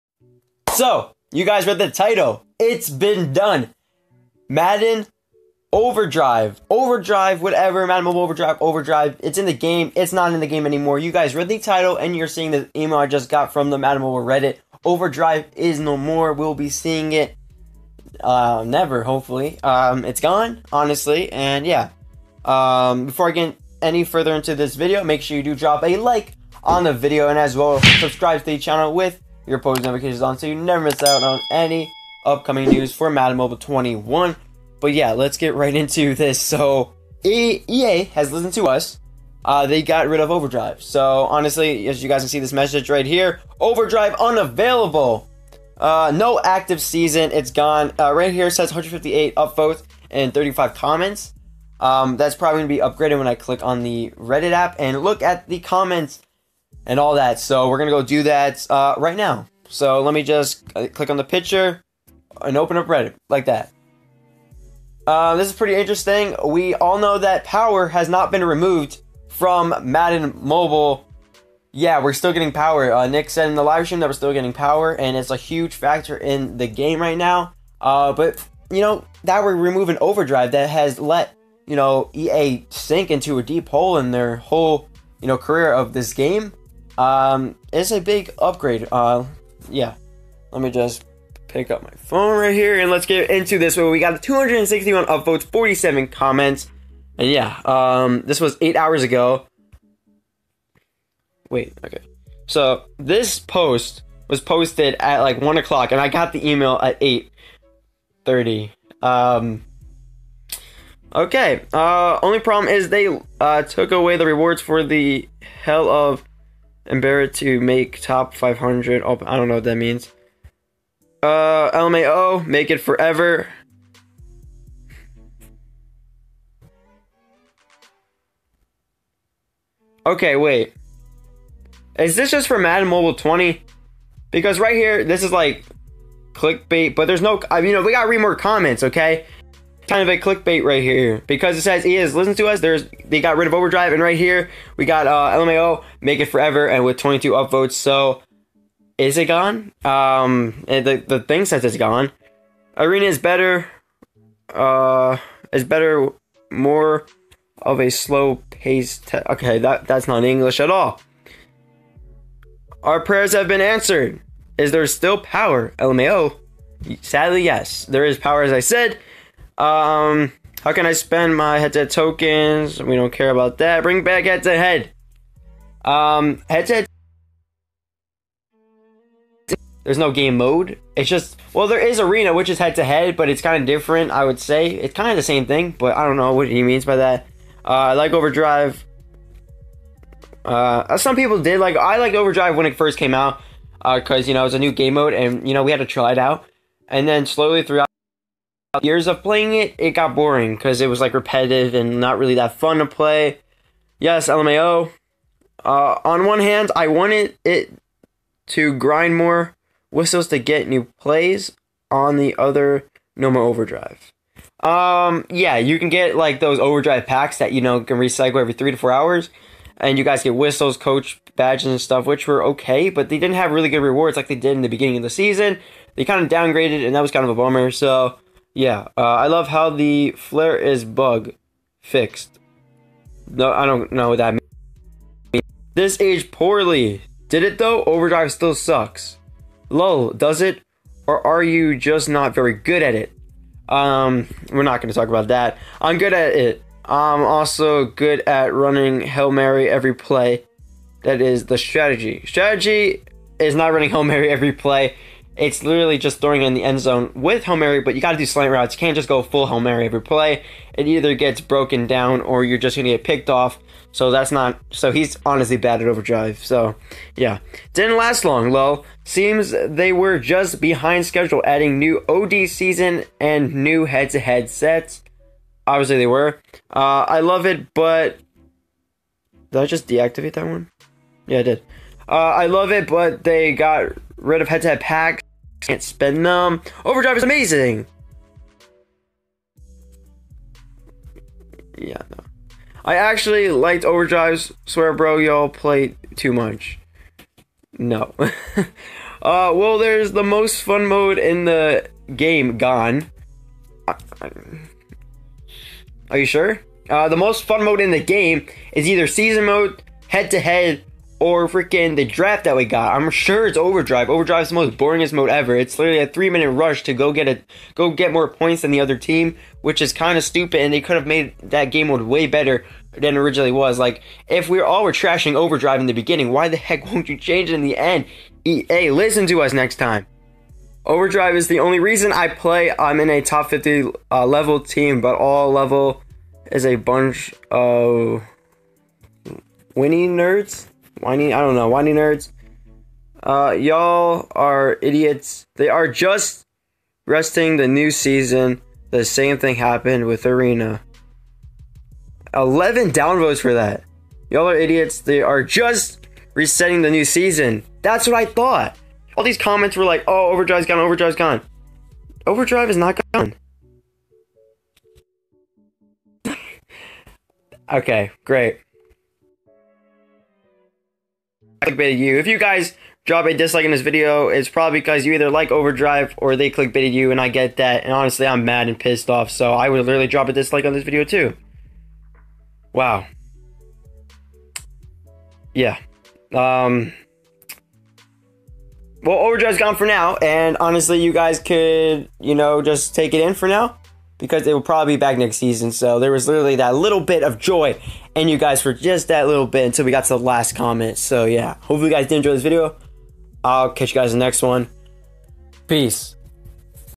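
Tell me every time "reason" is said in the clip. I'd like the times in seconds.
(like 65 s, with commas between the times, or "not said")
331 s.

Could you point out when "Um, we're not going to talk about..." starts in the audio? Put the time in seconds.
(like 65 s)
243 s.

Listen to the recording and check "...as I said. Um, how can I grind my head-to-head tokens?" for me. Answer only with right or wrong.
wrong.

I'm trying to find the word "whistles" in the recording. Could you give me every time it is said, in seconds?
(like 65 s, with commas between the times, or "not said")
209 s, 220 s.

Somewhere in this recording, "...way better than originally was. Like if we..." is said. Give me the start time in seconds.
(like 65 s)
322 s.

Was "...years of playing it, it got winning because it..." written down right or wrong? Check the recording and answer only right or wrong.
wrong.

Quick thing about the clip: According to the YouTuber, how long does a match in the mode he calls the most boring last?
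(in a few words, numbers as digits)
3 minutes.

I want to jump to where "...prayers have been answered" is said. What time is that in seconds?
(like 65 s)
163 s.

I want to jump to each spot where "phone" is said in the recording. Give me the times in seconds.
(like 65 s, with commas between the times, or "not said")
91 s.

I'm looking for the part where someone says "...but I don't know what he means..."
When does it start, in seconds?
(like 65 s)
185 s.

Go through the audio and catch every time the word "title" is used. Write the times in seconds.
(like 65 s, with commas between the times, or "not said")
1 s, 11 s.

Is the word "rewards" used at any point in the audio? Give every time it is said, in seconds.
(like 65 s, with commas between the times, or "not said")
114 s, 223 s.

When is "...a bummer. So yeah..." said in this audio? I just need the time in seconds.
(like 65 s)
227 s.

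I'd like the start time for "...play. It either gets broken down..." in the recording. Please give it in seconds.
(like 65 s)
260 s.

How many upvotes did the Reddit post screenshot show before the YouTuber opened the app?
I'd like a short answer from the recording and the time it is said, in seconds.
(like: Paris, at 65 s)
158, at 48 s.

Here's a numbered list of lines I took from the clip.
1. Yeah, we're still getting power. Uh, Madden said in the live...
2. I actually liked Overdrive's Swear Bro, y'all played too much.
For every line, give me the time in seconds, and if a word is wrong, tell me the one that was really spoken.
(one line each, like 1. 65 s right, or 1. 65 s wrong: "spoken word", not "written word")
1. 71 s wrong: "Nick", not "Madden"
2. 292 s right.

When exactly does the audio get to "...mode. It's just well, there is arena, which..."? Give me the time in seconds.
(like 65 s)
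180 s.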